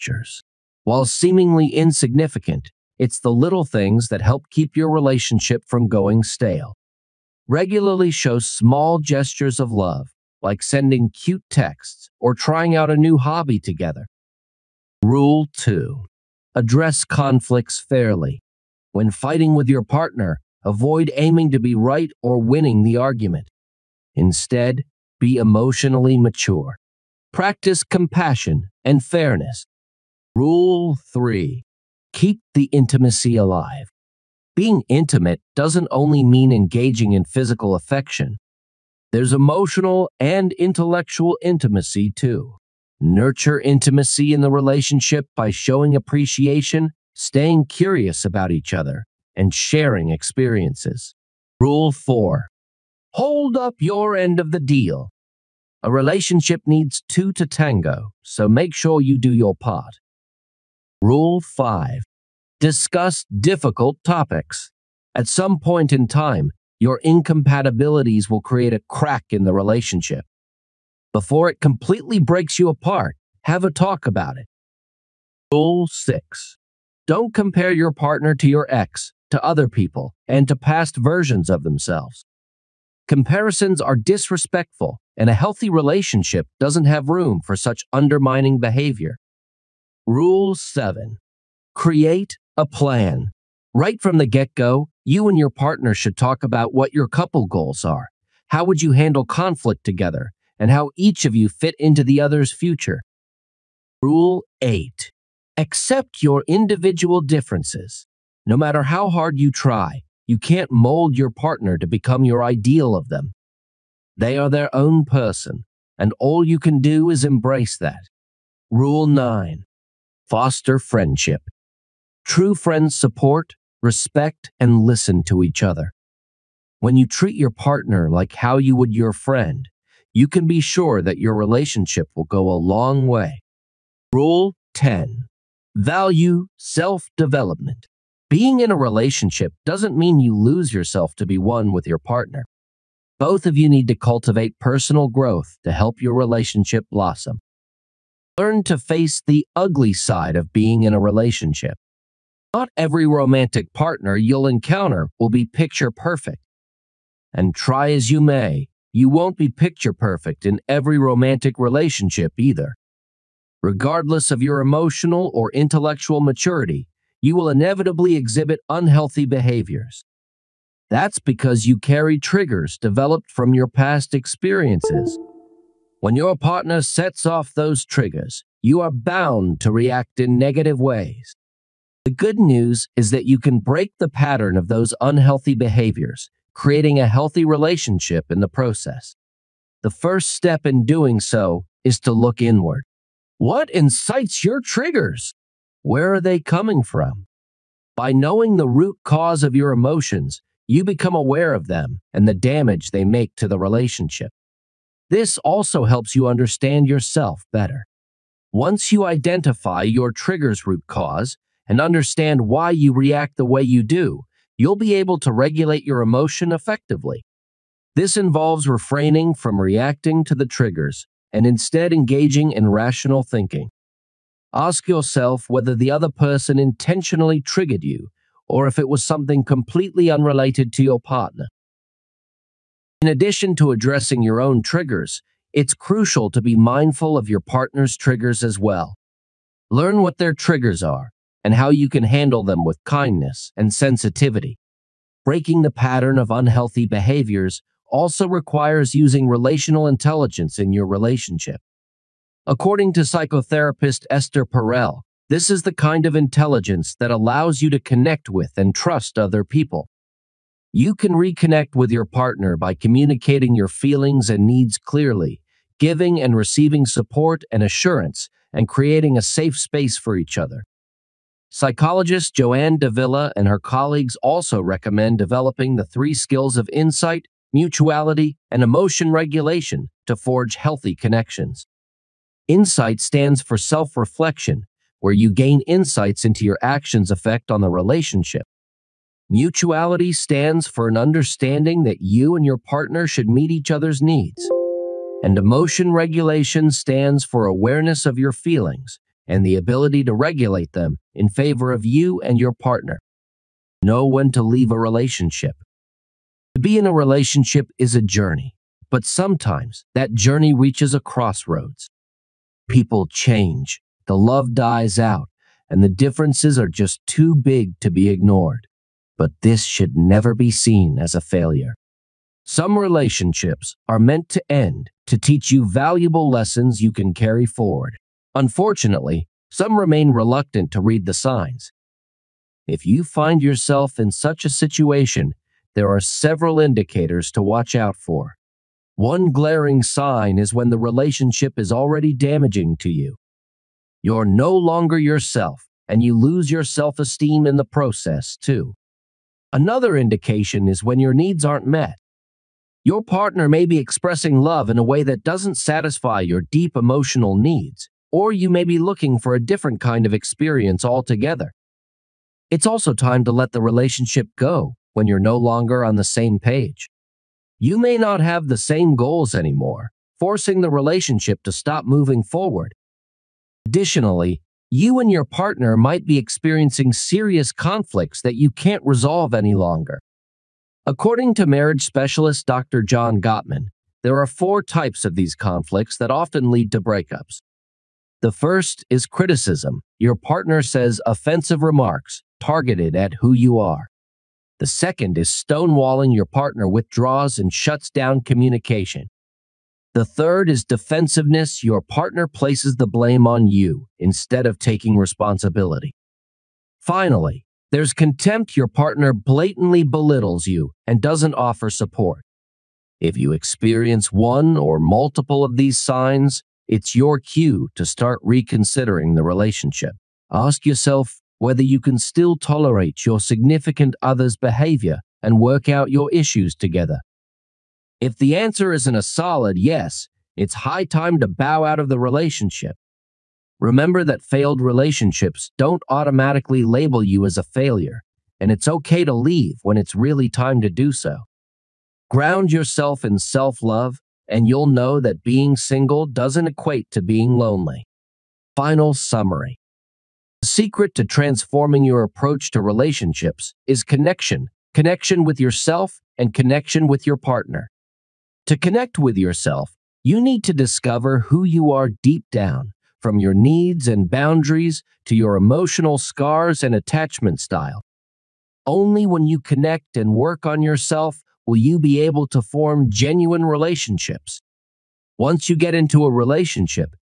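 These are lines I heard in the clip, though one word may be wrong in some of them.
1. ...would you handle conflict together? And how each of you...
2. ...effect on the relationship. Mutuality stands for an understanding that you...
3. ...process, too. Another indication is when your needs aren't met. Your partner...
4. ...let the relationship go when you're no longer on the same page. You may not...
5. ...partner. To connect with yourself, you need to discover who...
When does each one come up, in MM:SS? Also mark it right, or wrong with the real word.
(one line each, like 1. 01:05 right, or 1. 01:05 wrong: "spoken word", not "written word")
1. 01:38 right
2. 04:47 right
3. 05:47 right
4. 06:03 right
5. 07:37 right.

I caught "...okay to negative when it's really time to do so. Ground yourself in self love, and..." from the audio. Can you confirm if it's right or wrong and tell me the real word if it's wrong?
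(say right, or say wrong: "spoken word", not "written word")
wrong: "leave", not "negative".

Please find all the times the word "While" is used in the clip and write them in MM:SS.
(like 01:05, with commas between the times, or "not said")
00:00.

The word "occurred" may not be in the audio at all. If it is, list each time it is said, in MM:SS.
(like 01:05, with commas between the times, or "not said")
not said.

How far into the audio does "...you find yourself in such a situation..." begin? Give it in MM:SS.
05:32.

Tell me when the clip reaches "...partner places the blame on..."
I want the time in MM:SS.
06:41.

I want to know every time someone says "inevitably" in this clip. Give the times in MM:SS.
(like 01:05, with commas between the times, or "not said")
02:47.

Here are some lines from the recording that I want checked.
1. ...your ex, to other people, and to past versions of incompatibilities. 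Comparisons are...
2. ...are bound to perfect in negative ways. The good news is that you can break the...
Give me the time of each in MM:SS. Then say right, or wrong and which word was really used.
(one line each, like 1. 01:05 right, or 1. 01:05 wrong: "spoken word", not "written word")
1. 01:18 wrong: "themselves", not "incompatibilities"
2. 02:58 wrong: "react", not "perfect".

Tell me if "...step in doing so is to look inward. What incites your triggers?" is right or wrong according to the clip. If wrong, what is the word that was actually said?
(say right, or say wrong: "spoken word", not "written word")
right.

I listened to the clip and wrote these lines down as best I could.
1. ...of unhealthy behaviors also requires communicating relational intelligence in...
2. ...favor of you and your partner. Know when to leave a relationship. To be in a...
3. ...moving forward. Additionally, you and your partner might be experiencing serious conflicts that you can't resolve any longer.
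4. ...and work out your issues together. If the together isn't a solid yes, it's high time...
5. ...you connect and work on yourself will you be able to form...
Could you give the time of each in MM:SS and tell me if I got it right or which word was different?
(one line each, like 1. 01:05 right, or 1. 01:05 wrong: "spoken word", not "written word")
1. 04:06 wrong: "using", not "communicating"
2. 05:01 right
3. 06:11 right
4. 07:05 wrong: "answer", not "together"
5. 07:49 right.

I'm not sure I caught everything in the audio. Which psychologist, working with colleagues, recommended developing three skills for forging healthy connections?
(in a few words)
Joanne Davila.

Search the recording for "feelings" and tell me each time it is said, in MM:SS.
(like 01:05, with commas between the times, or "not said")
04:23, 04:58.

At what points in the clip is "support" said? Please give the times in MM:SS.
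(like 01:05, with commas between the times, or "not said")
02:02, 04:26, 06:51.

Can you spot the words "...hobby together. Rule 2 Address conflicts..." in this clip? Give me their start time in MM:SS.
00:13.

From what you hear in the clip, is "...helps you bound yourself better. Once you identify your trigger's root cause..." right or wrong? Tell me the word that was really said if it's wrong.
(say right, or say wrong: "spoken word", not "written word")
wrong: "understand", not "bound".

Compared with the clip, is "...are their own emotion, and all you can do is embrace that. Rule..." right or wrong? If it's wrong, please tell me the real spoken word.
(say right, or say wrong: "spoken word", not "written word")
wrong: "person", not "emotion".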